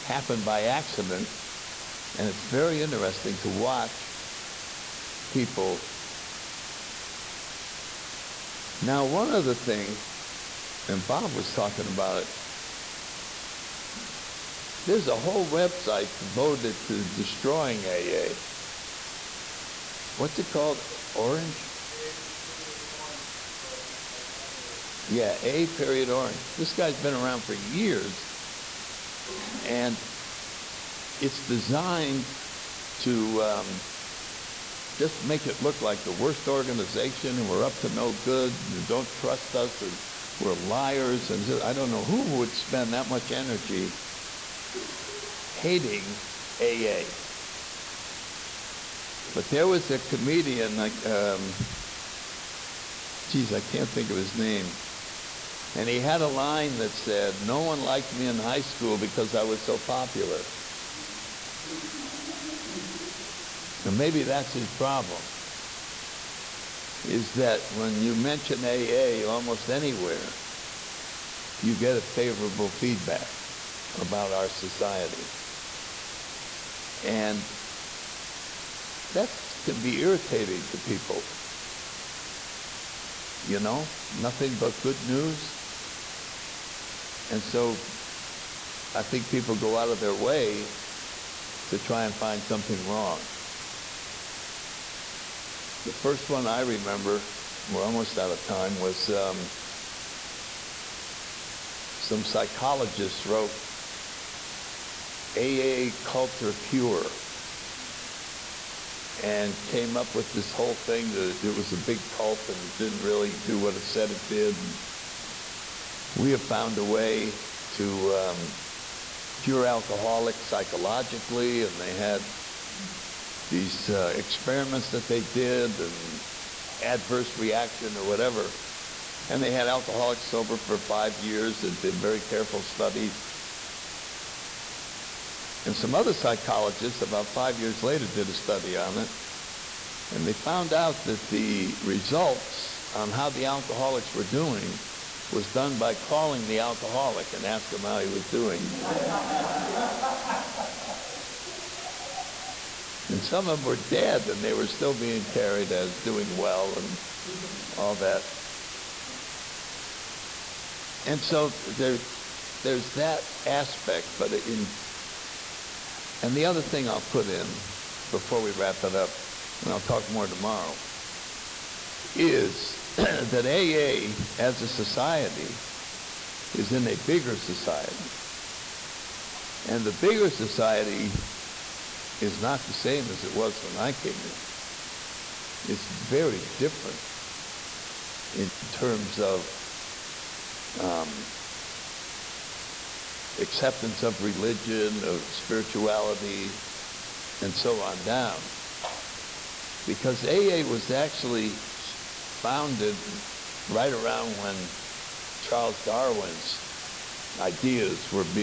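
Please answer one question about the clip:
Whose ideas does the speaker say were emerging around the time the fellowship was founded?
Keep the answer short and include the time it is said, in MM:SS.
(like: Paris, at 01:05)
Charles Darwin, at 03:25.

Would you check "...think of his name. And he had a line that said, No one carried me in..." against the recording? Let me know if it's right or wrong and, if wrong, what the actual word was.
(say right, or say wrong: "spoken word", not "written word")
wrong: "liked", not "carried".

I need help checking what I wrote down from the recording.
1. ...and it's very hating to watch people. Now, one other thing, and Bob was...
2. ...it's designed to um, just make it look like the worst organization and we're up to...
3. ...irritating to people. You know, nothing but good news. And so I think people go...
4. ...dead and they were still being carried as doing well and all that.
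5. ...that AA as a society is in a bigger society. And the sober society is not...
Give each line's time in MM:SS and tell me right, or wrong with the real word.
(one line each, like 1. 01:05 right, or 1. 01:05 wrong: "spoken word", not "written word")
1. 00:02 wrong: "interesting", not "hating"
2. 00:31 right
3. 01:19 right
4. 02:33 right
5. 02:52 wrong: "bigger", not "sober".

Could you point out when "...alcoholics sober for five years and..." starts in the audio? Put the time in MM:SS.
02:09.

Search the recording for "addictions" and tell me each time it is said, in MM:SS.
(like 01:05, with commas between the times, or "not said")
not said.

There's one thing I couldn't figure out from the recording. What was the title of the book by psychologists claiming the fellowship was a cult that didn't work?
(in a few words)
AA Cult or Cure.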